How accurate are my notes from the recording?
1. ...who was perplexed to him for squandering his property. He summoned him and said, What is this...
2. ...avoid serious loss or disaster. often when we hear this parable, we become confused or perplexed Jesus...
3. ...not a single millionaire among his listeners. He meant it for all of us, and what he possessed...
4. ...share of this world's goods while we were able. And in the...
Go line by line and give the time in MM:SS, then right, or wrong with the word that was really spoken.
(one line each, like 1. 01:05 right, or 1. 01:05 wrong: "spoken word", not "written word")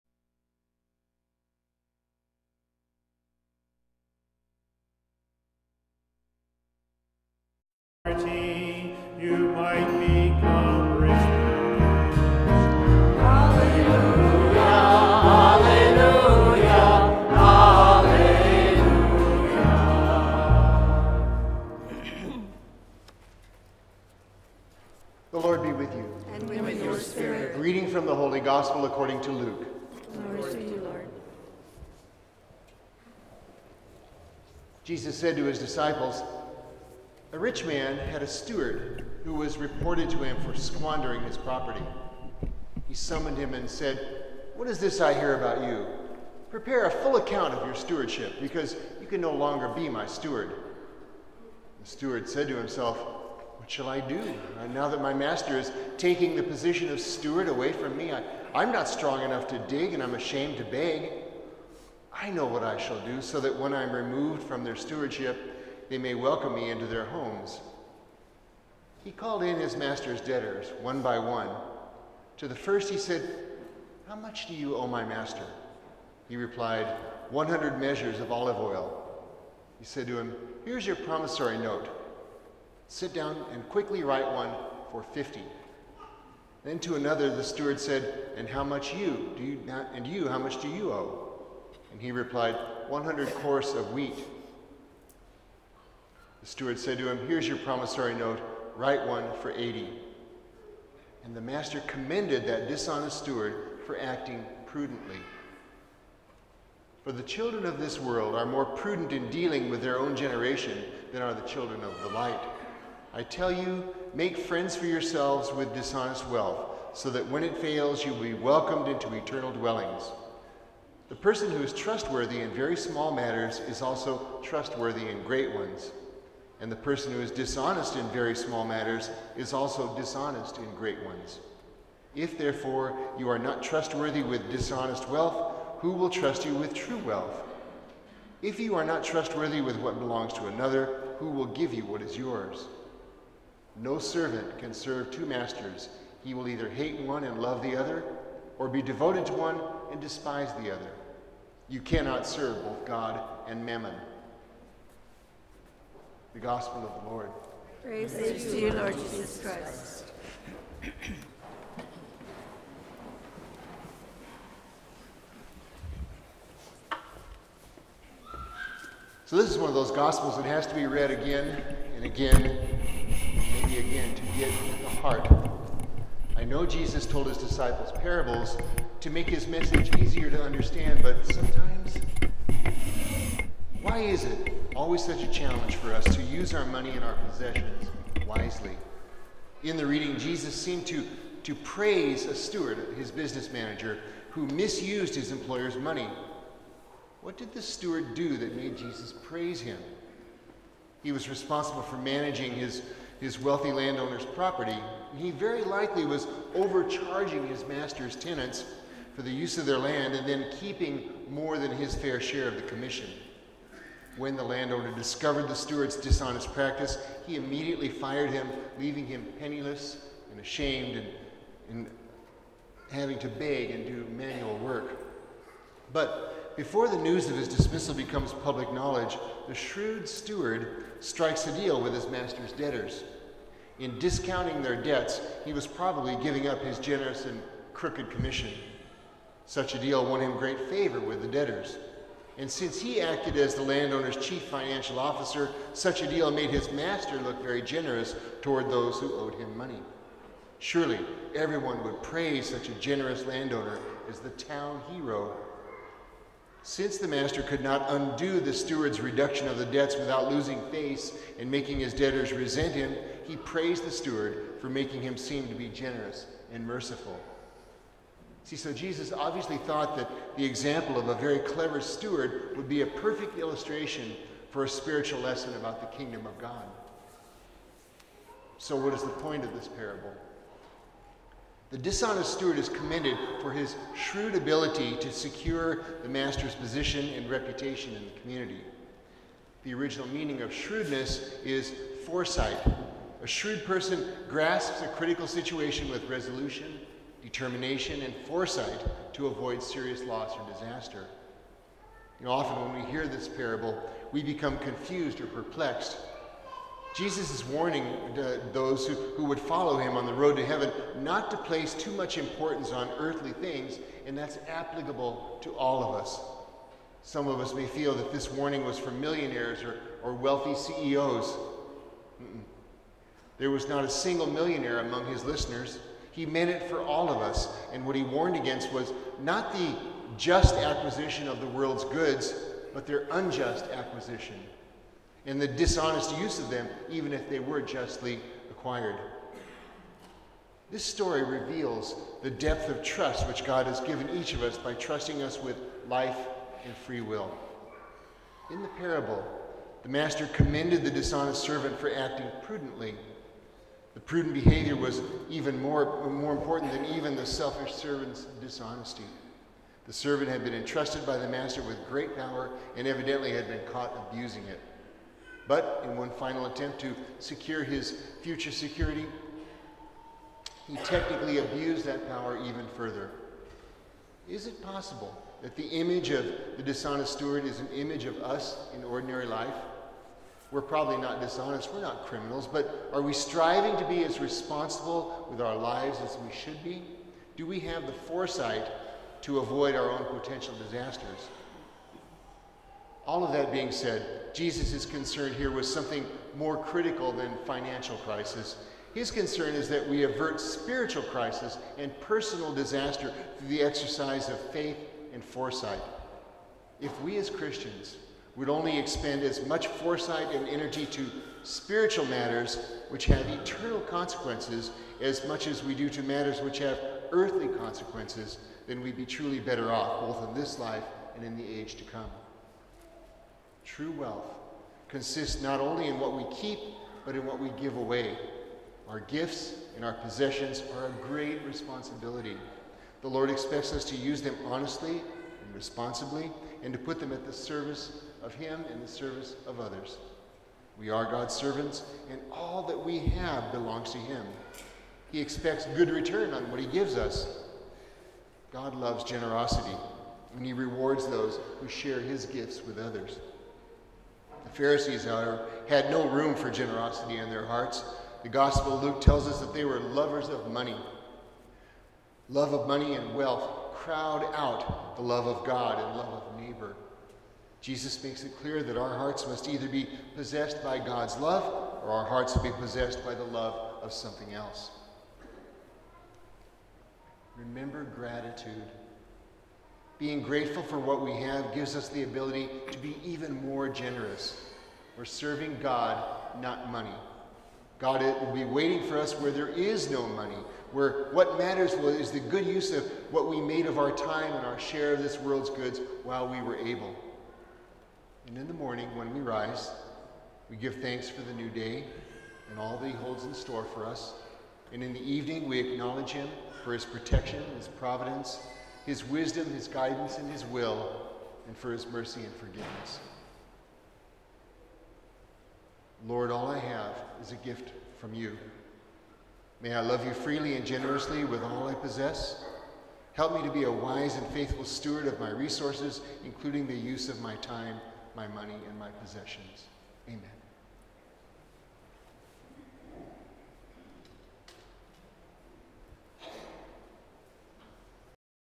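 1. 00:39 wrong: "reported", not "perplexed"
2. 04:59 right
3. 05:23 wrong: "warned", not "possessed"
4. 08:14 right.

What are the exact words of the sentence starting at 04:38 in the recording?
So, what is the point of this parable?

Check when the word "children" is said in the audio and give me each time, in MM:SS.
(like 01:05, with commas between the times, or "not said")
01:47, 01:51.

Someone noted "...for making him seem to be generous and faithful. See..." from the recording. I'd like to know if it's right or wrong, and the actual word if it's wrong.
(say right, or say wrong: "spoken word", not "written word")
wrong: "merciful", not "faithful".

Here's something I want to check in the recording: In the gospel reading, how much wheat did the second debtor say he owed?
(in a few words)
100 kors.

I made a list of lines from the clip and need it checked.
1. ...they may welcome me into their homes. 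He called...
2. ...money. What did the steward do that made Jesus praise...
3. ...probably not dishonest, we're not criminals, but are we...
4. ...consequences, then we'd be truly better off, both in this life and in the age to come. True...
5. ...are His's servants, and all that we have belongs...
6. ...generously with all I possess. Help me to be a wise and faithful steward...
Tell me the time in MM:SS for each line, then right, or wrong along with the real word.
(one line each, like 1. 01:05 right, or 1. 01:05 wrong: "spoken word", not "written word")
1. 01:05 right
2. 03:15 right
3. 06:20 right
4. 06:57 right
5. 07:20 wrong: "God", not "His"
6. 08:40 right.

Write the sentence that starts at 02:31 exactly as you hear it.
You cannot serve both God and mammon.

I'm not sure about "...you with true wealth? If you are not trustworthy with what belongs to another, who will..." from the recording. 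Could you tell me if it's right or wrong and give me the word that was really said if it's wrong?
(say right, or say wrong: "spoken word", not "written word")
right.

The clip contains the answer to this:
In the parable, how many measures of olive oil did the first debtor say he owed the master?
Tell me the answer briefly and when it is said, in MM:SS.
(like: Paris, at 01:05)
100, at 01:17.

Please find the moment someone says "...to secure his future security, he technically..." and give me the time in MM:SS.
06:06.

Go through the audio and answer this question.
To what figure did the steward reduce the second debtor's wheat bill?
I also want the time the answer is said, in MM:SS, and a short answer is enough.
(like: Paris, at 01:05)
80, at 01:39.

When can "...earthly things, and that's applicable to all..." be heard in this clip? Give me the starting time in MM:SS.
05:12.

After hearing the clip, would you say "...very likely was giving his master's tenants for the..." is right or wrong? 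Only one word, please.
wrong.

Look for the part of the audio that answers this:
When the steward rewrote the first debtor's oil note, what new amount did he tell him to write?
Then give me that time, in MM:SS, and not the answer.
01:25.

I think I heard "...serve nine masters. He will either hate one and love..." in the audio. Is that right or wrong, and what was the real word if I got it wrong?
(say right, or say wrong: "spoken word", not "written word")
wrong: "two", not "nine".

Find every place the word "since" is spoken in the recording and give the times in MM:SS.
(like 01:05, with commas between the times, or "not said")
04:02, 04:16.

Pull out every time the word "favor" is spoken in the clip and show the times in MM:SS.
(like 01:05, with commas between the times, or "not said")
04:00.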